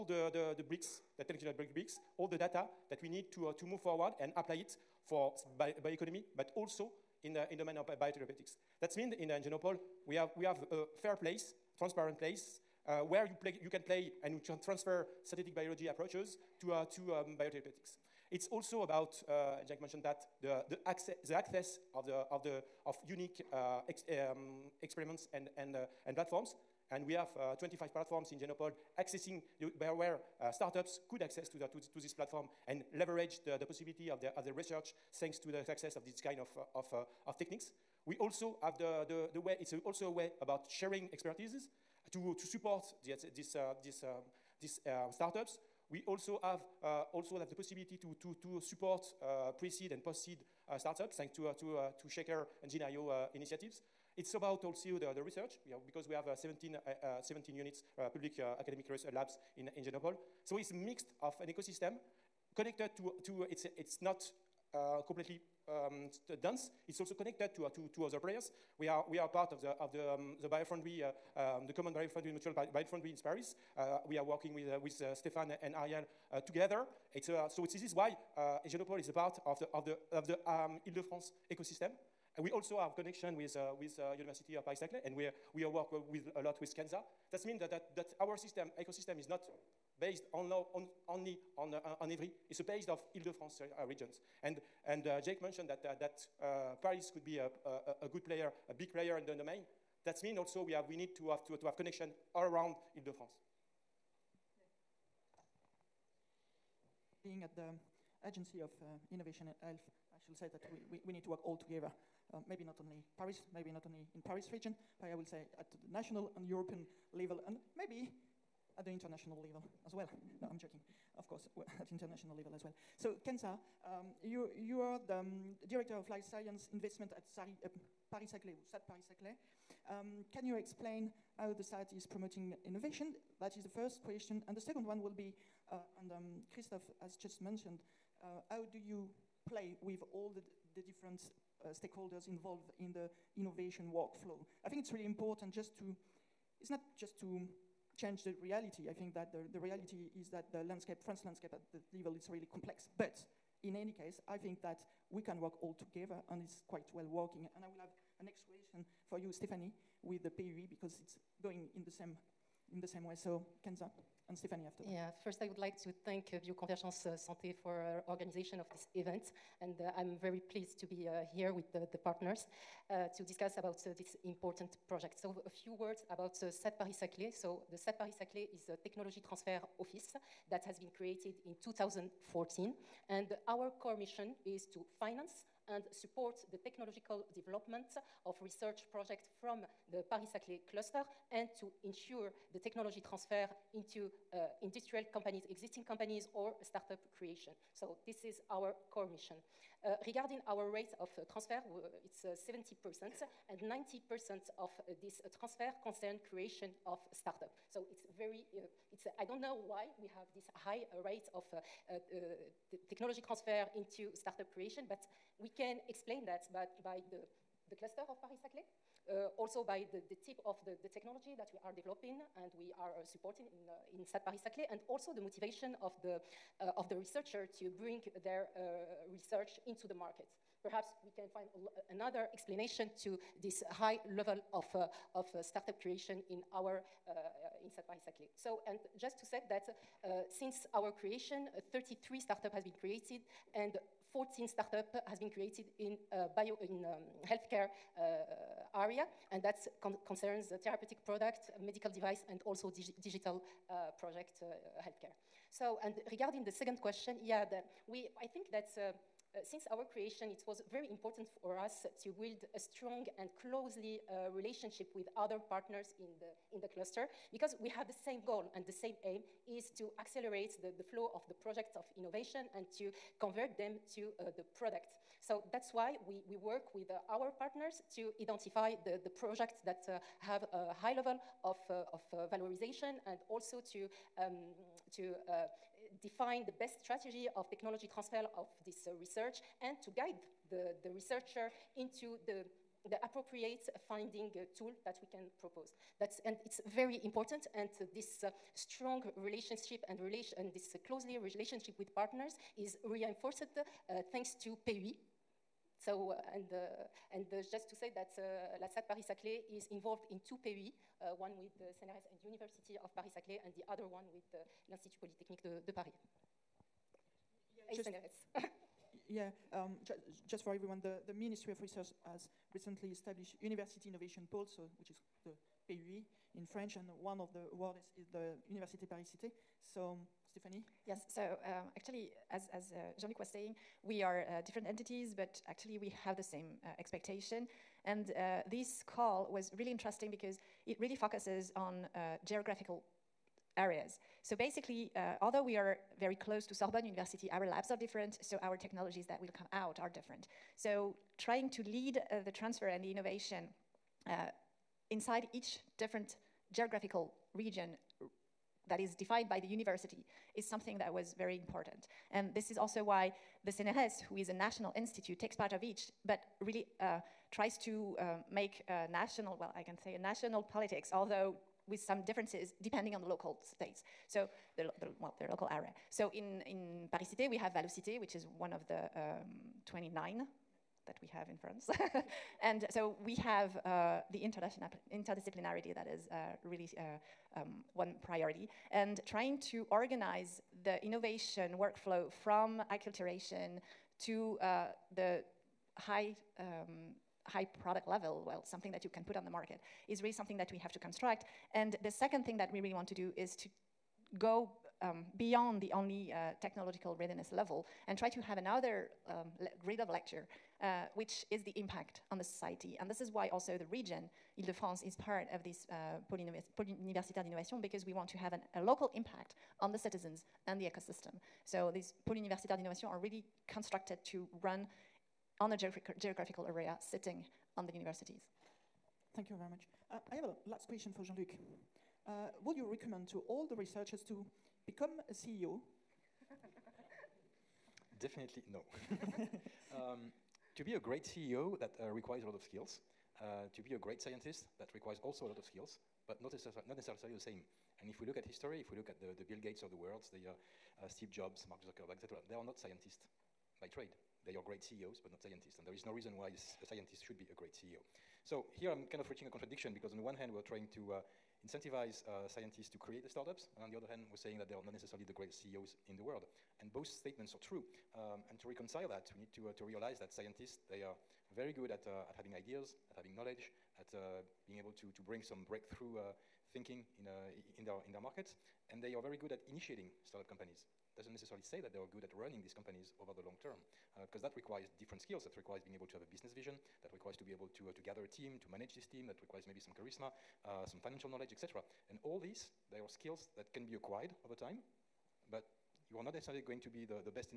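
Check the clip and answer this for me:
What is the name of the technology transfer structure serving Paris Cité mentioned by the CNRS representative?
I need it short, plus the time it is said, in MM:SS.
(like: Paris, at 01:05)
Valocité, at 06:17.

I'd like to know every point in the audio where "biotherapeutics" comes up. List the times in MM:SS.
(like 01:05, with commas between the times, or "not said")
00:07, 00:17.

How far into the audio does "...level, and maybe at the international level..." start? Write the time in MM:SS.
01:57.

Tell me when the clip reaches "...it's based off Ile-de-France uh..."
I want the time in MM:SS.
01:32.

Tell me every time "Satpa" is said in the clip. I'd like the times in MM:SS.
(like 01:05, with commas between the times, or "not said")
03:57.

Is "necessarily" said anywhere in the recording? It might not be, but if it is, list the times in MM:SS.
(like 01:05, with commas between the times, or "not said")
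07:26, 07:44, 08:01, 08:16.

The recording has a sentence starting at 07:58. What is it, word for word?
And they are very good at initiating startup companies.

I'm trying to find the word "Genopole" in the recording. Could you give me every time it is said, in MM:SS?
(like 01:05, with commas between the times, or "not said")
00:09, 00:28, 00:59, 01:18.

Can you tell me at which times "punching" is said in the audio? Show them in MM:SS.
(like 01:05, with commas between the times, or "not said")
not said.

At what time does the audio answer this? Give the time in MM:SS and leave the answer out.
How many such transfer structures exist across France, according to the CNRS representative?
06:19.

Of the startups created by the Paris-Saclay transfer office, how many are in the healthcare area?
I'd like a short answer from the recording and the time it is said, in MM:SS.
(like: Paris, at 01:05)
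14, at 04:04.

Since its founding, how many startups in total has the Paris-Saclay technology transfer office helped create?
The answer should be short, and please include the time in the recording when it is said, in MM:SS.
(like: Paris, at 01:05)
33, at 04:01.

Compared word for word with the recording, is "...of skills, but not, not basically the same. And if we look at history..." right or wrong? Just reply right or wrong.
wrong.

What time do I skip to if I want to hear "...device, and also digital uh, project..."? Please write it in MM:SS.
04:11.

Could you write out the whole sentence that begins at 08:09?
That requires maybe some charisma, uh, some financial knowledge, etc.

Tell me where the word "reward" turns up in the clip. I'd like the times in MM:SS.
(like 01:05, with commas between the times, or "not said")
not said.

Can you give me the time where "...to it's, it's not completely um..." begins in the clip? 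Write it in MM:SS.
01:03.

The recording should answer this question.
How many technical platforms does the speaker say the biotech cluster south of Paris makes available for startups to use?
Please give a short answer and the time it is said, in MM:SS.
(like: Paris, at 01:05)
25, at 00:27.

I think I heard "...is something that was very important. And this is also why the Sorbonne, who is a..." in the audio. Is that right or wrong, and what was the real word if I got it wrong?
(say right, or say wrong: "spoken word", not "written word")
wrong: "CNRS", not "Sorbonne".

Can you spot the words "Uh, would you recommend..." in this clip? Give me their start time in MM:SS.
07:12.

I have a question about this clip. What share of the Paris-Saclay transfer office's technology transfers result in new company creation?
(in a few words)
90%.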